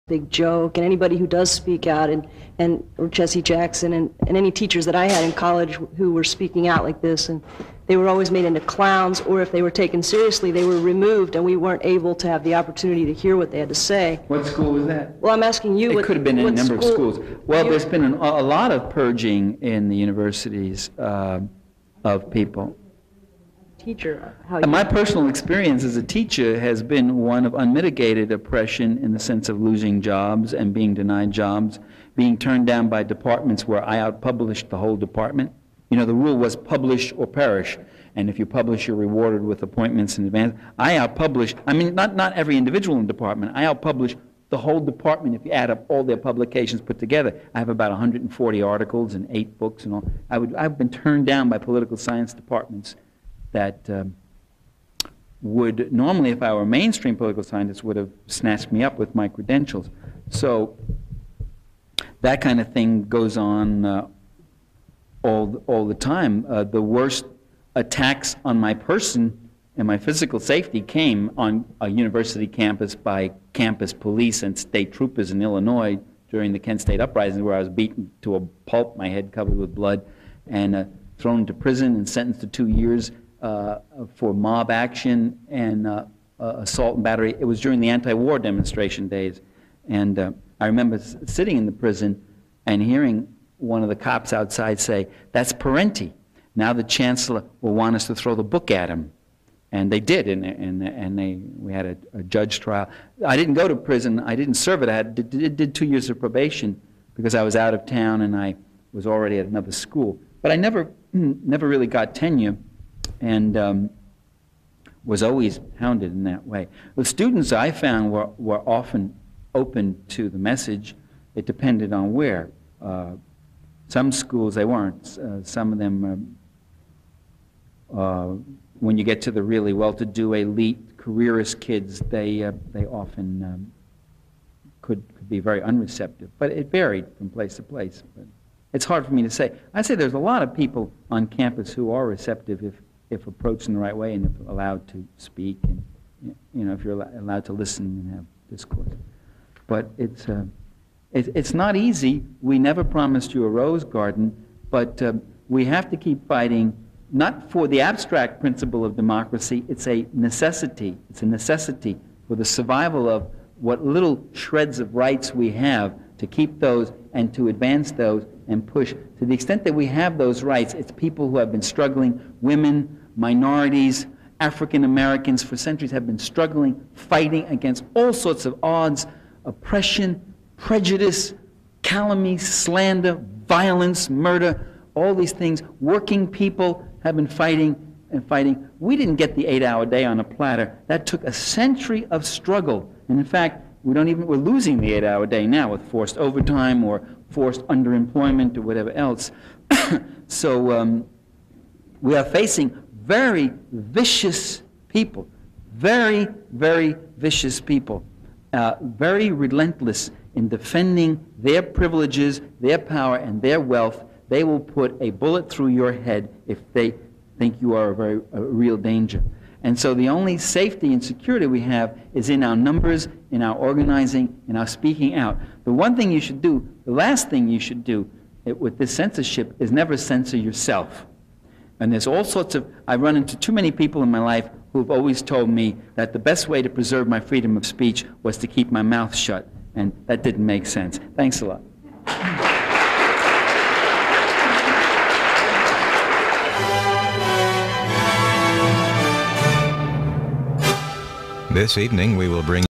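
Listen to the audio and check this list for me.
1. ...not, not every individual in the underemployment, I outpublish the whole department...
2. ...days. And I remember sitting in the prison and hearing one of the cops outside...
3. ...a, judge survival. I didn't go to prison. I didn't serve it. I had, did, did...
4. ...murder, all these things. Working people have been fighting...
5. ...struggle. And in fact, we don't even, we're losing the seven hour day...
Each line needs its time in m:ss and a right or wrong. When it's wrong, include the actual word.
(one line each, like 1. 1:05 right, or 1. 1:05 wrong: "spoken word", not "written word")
1. 0:41 wrong: "department", not "underemployment"
2. 1:29 right
3. 1:42 wrong: "trial", not "survival"
4. 3:04 right
5. 3:12 wrong: "eight", not "seven".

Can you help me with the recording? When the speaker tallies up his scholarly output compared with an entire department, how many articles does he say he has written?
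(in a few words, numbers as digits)
140.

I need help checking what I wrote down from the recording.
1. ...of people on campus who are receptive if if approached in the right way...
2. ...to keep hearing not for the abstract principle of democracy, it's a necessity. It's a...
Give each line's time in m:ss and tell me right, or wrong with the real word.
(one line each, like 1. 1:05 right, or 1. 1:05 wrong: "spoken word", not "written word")
1. 2:20 right
2. 2:35 wrong: "fighting", not "hearing".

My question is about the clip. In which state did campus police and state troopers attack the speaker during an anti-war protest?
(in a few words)
Illinois.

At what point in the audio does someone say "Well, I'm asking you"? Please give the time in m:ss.
0:15.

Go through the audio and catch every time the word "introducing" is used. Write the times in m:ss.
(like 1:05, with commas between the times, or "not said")
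not said.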